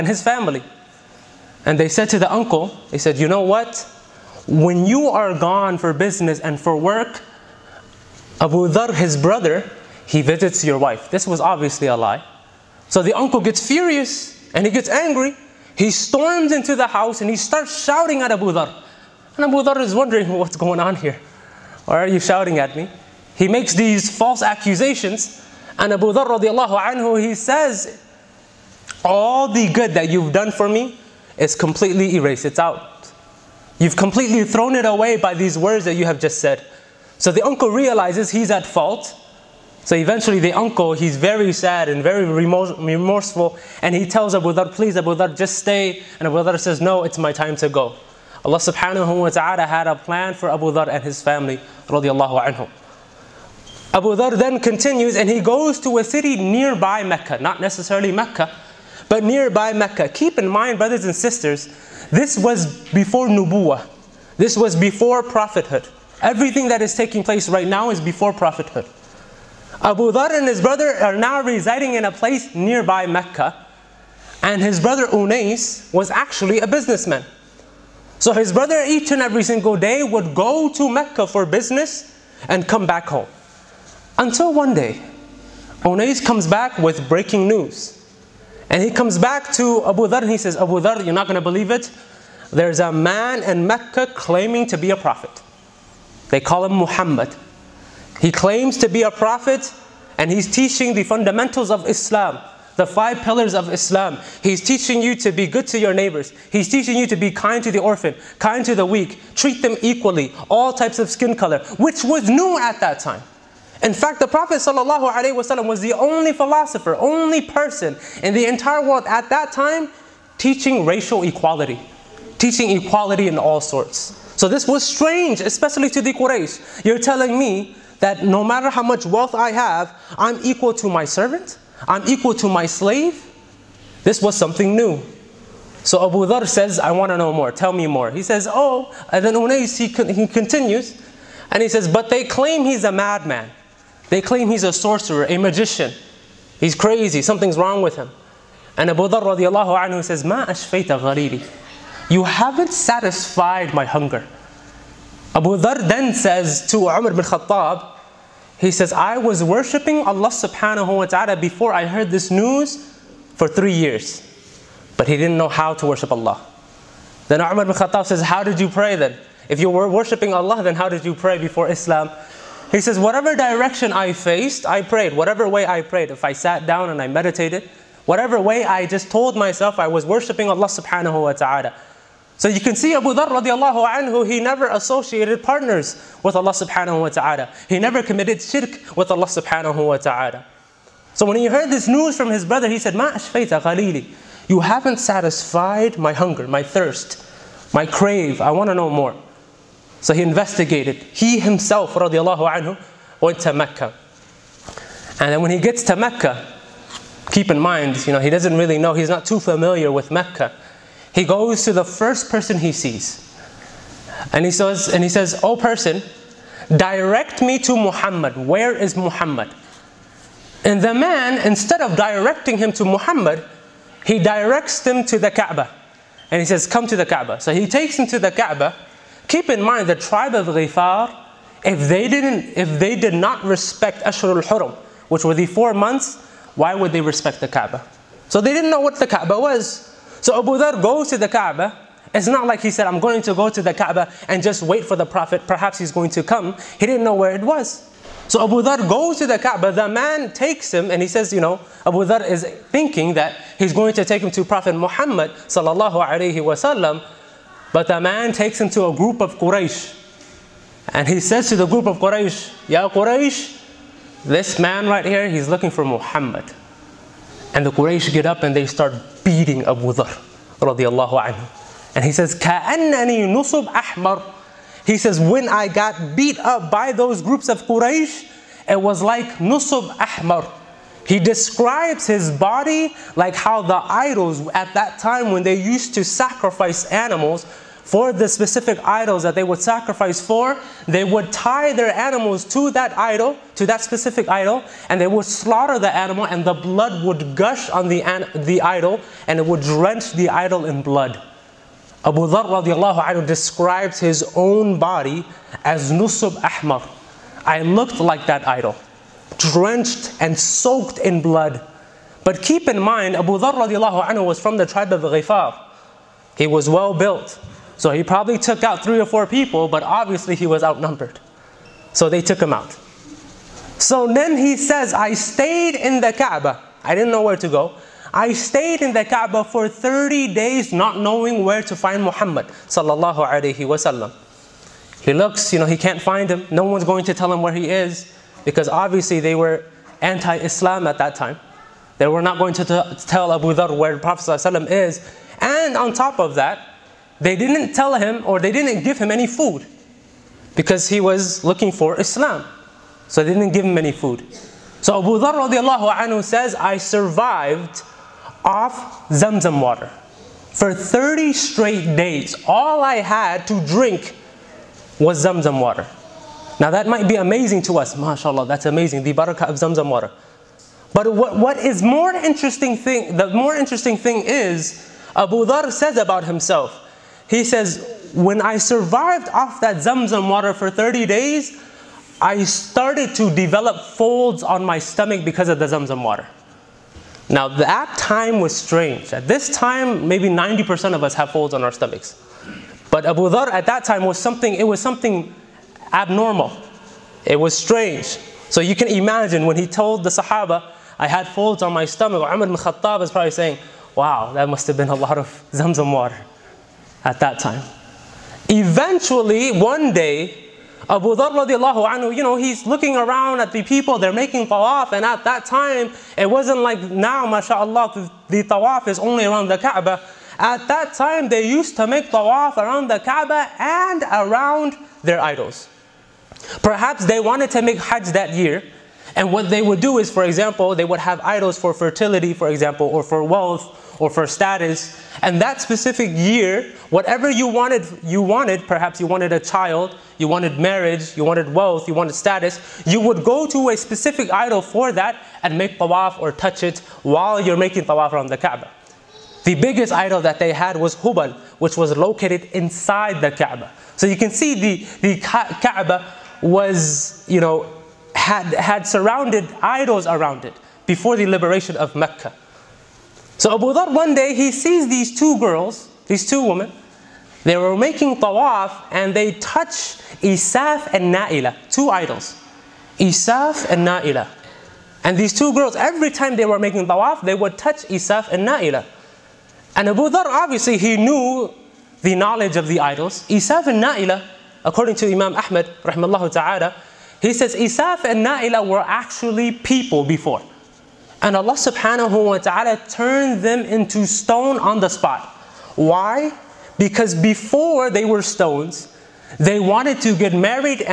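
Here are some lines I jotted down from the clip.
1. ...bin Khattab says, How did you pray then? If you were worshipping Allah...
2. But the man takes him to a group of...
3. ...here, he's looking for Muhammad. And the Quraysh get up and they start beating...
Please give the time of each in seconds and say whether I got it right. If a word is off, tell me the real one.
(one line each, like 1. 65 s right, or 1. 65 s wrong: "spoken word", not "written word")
1. 167 s right
2. 257 s right
3. 265 s right.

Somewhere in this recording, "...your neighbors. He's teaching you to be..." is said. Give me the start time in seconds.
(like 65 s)
105 s.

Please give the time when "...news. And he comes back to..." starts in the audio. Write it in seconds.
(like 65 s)
87 s.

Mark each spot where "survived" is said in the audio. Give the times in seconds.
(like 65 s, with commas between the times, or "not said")
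356 s, 378 s.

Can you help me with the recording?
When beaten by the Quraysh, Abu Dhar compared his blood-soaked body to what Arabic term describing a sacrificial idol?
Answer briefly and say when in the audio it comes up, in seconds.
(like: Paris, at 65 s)
Nusub Ahmar, at 305 s.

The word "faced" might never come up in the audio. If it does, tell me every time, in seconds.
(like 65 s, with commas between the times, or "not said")
174 s.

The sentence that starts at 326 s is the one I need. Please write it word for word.
I didn't know where to go.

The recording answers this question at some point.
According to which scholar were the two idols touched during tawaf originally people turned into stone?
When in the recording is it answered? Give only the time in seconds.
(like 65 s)
485 s.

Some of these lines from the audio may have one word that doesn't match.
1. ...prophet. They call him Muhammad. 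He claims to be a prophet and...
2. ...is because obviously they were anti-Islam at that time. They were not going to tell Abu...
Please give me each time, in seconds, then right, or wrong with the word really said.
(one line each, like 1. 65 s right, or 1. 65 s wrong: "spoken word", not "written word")
1. 94 s right
2. 337 s right.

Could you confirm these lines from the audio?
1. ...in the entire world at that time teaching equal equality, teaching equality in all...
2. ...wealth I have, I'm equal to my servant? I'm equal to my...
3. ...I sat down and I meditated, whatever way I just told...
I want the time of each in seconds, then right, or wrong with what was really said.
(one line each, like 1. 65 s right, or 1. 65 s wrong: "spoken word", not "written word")
1. 118 s wrong: "racial", not "equal"
2. 129 s right
3. 176 s right.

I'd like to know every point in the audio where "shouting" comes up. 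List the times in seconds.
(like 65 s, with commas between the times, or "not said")
17 s, 22 s.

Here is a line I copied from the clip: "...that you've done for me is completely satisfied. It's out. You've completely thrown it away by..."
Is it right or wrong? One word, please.
wrong.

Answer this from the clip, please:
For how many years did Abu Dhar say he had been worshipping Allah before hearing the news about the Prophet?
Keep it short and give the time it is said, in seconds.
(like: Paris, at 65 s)
3, at 163 s.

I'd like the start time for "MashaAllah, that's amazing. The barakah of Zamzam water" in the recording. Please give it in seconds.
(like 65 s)
367 s.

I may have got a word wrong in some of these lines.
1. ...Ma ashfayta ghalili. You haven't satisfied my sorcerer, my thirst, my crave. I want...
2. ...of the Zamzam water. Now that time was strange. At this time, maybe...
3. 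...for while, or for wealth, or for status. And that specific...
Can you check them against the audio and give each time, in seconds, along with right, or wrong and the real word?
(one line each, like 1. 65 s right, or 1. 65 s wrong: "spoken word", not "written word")
1. 192 s wrong: "hunger", not "sorcerer"
2. 385 s right
3. 432 s wrong: "example", not "while".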